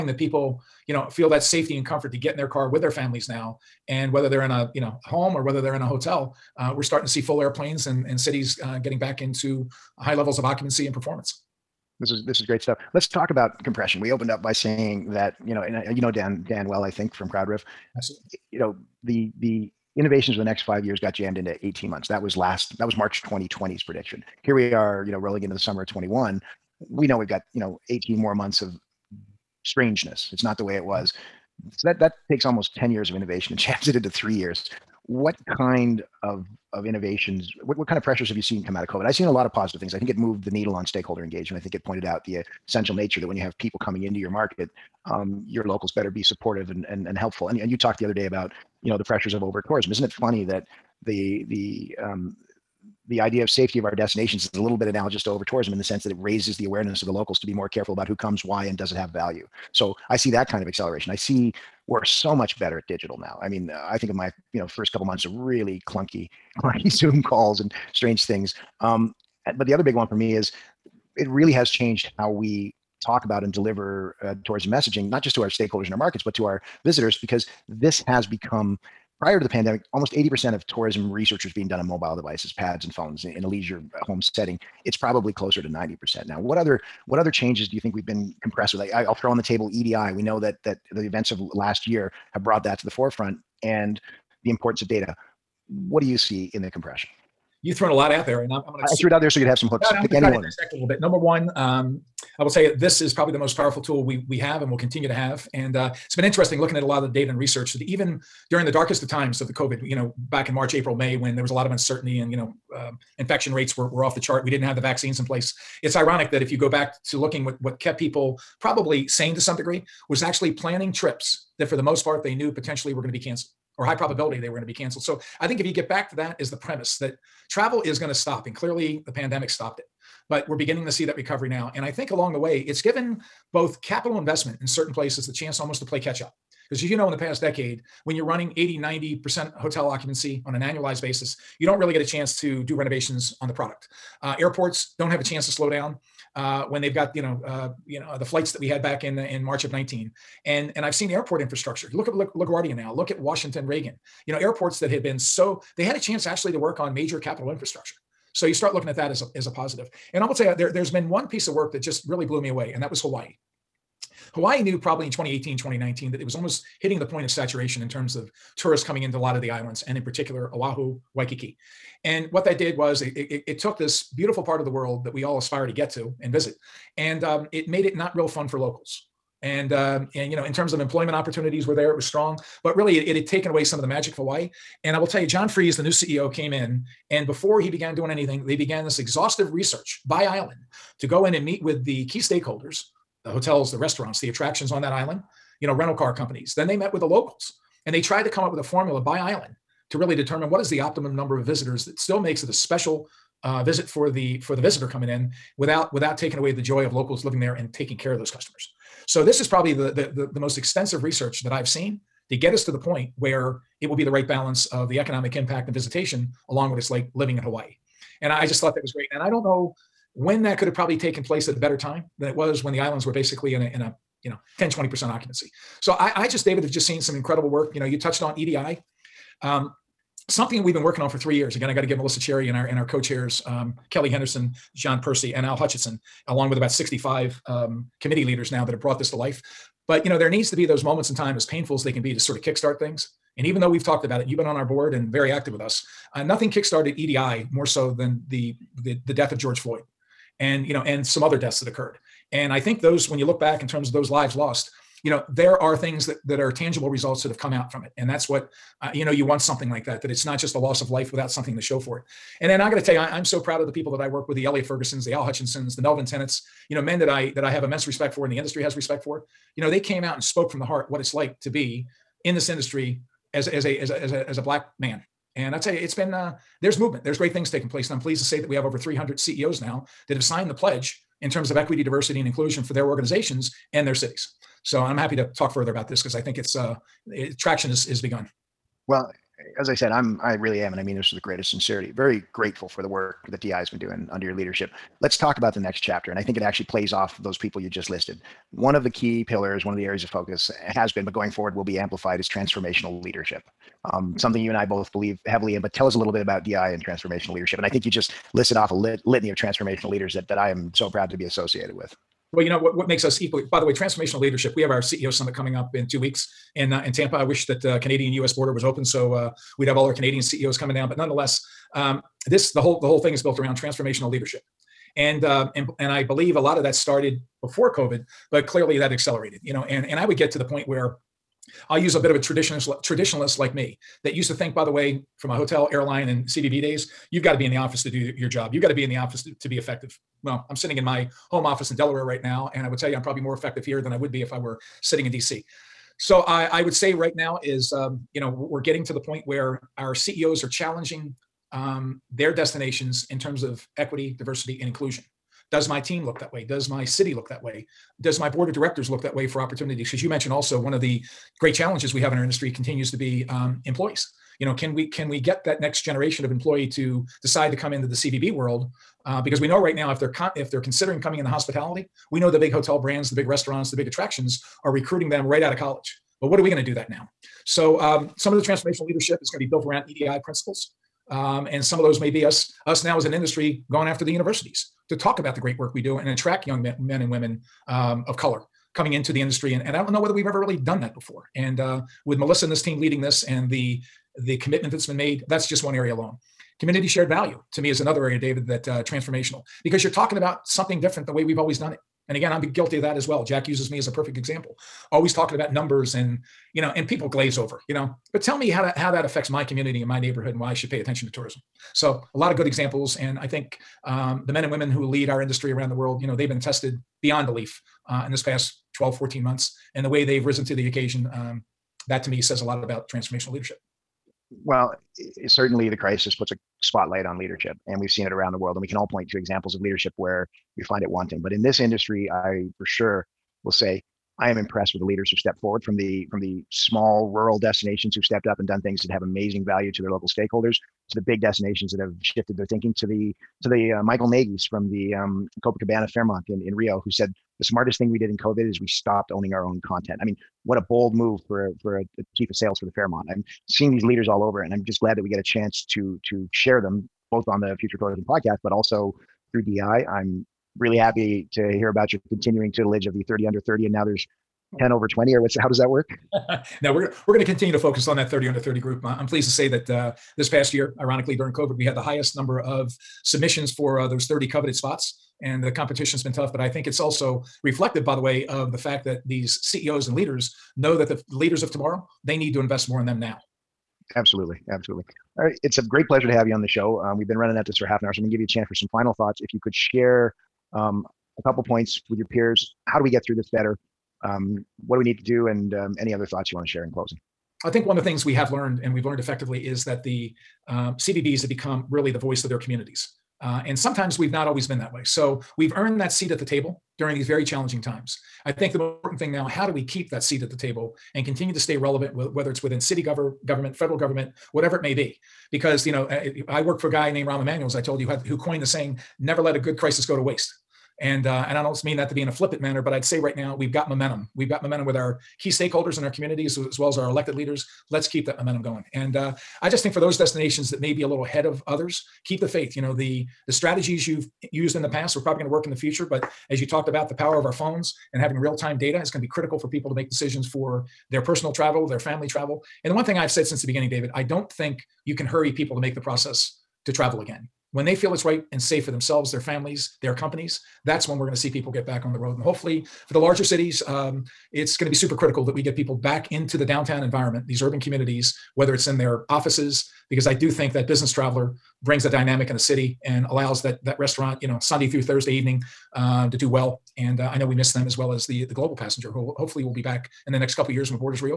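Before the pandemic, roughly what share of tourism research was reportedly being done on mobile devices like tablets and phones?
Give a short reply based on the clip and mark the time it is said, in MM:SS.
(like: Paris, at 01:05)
80%, at 01:19.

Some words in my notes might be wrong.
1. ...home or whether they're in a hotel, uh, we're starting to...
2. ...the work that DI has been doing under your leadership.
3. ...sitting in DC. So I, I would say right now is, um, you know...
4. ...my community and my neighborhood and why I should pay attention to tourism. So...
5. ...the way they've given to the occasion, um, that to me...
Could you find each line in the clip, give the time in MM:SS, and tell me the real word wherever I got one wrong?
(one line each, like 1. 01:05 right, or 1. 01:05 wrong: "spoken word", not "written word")
1. 00:05 right
2. 04:52 right
3. 05:44 right
4. 06:49 right
5. 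06:59 wrong: "risen", not "given".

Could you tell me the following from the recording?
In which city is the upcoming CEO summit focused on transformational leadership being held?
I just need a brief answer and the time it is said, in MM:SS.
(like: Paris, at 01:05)
Tampa, at 05:16.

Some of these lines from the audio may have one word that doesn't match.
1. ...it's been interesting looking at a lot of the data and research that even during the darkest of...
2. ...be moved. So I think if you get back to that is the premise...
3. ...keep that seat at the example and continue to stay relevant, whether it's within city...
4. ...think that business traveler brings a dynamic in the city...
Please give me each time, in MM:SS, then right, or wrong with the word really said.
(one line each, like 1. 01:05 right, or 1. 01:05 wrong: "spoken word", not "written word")
1. 01:46 right
2. 02:04 wrong: "canceled", not "moved"
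3. 08:29 wrong: "table", not "example"
4. 09:20 right.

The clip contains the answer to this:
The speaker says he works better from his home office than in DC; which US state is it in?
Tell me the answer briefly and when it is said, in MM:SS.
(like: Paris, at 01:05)
Delaware, at 05:41.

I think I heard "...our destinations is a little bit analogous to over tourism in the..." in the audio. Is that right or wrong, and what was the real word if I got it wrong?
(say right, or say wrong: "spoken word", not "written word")
right.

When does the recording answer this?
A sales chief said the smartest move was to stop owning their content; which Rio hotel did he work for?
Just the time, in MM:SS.
07:25.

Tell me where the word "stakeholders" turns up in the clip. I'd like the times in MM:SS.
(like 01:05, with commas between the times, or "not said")
00:40, 01:15, 03:12, 07:20, 08:45.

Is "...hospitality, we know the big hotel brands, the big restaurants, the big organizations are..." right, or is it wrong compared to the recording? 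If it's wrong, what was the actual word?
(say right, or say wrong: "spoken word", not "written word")
wrong: "attractions", not "organizations".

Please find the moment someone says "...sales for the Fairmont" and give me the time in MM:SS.
07:32.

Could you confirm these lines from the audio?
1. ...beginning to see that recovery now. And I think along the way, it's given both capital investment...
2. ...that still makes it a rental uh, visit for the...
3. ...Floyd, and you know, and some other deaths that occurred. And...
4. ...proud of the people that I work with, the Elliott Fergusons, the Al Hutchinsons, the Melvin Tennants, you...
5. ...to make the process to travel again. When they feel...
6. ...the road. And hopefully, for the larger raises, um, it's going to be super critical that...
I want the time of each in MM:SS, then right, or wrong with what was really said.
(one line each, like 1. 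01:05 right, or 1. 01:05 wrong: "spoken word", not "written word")
1. 02:10 right
2. 03:21 wrong: "special", not "rental"
3. 04:09 right
4. 04:23 right
5. 09:05 right
6. 09:11 wrong: "cities", not "raises".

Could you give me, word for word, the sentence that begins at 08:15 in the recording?
And um, any other thoughts you want to share in closing?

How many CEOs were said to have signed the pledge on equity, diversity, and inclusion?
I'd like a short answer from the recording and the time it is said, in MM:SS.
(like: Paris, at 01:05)
300, at 04:38.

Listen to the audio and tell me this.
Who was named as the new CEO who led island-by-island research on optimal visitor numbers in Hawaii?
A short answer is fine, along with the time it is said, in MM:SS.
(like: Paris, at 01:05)
John Freeze, at 03:05.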